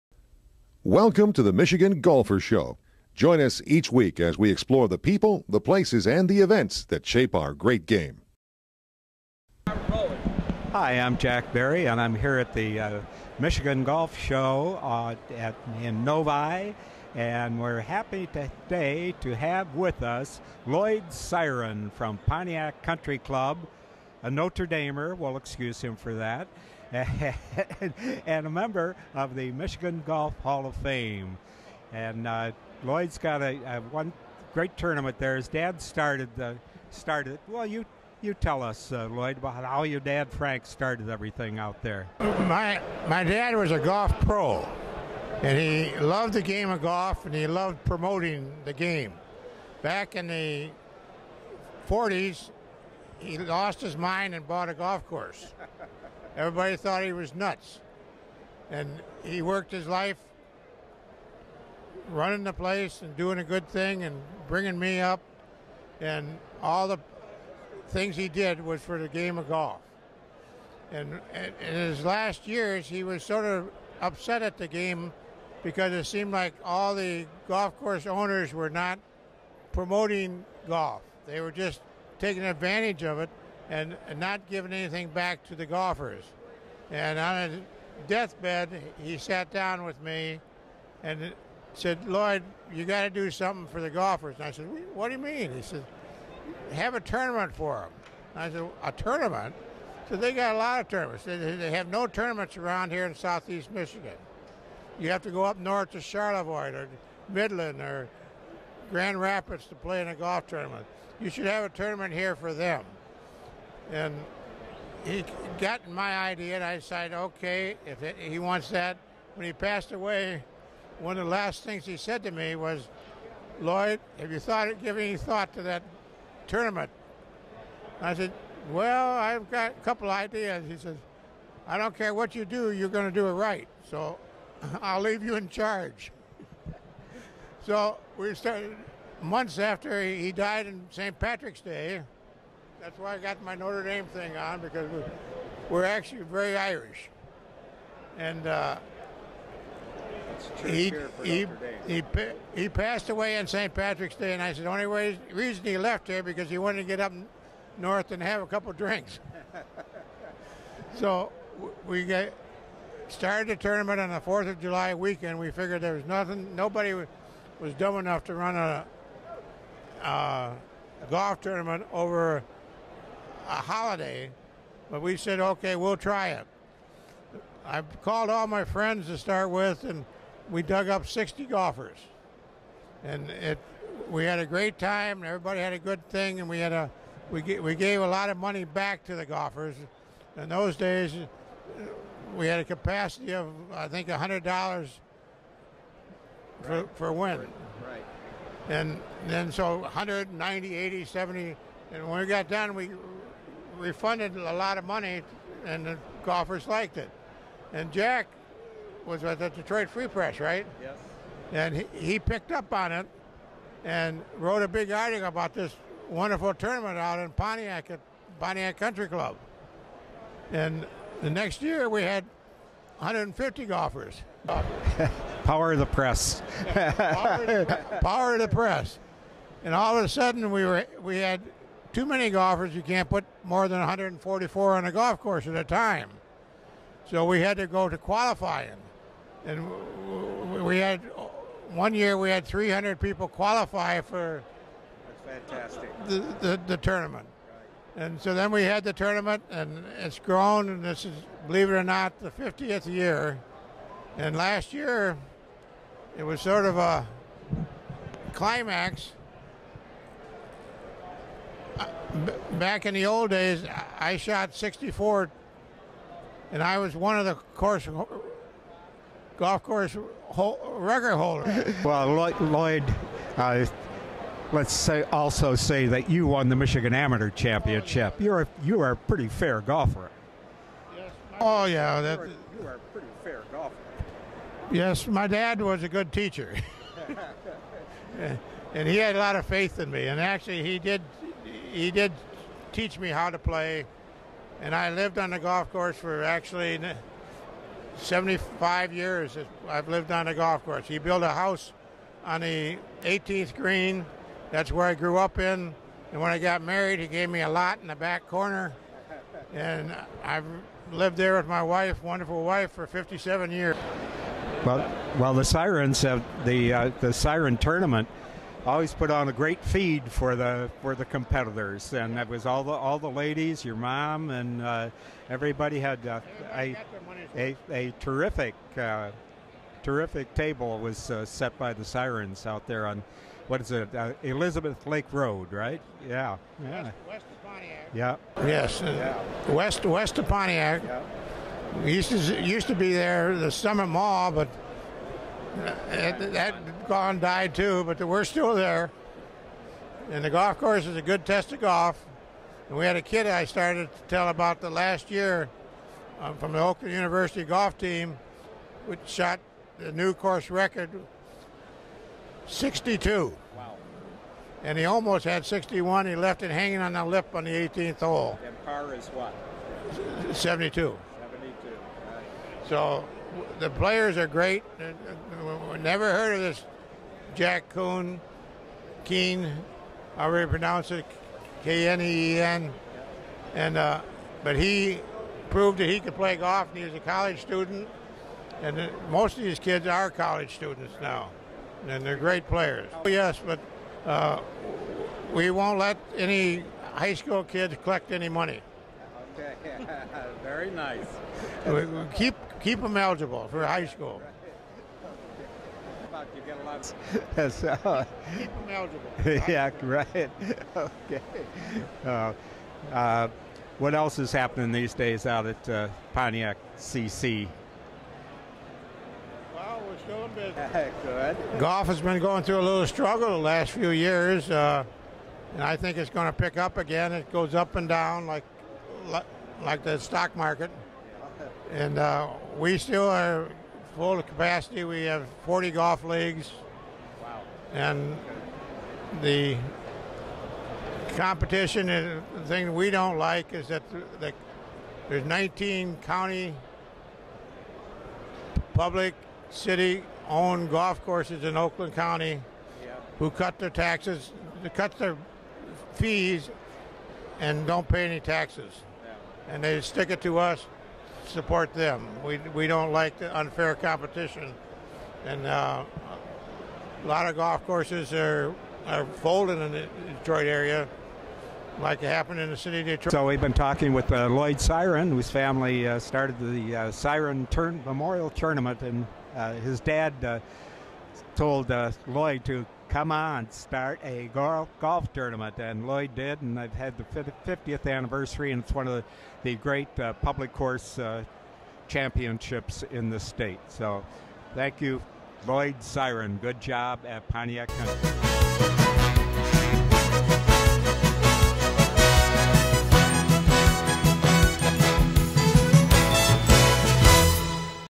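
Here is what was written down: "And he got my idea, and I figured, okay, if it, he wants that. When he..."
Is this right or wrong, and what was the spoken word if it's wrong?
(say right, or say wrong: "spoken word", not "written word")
wrong: "decided", not "figured".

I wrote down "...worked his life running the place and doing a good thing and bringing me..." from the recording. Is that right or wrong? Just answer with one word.
right.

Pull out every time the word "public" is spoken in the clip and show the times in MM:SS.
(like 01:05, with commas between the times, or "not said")
07:28, 08:10.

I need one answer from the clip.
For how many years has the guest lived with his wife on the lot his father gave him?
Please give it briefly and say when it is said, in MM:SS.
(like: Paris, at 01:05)
57, at 05:12.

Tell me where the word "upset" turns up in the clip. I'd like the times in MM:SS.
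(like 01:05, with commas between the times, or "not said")
01:14.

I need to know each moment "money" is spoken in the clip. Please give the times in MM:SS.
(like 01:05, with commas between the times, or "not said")
03:08, 03:24, 06:38.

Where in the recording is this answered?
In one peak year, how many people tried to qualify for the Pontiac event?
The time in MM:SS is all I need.
04:02.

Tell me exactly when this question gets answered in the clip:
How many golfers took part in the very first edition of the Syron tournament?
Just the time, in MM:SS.
03:01.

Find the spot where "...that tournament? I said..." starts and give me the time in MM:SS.
02:05.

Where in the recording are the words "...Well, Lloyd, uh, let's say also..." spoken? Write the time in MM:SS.
04:31.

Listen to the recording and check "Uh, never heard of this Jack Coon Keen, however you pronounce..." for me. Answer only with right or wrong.
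right.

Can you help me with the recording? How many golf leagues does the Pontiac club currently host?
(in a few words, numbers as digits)
40.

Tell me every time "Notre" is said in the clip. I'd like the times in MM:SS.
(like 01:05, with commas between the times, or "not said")
00:24, 02:23.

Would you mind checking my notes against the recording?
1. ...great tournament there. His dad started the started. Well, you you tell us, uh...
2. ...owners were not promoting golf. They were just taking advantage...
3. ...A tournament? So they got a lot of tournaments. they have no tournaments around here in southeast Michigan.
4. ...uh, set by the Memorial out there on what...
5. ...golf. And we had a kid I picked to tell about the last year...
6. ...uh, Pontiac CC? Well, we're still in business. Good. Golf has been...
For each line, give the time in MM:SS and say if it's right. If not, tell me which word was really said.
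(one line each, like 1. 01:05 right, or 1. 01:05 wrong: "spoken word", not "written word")
1. 00:34 right
2. 01:18 right
3. 01:38 right
4. 05:31 wrong: "Syrons", not "Memorial"
5. 05:51 wrong: "started", not "picked"
6. 06:55 right.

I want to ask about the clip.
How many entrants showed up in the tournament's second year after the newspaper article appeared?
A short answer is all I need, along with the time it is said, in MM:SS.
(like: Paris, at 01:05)
150, at 03:42.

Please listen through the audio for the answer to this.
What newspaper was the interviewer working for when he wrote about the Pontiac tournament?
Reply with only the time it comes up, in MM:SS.
03:29.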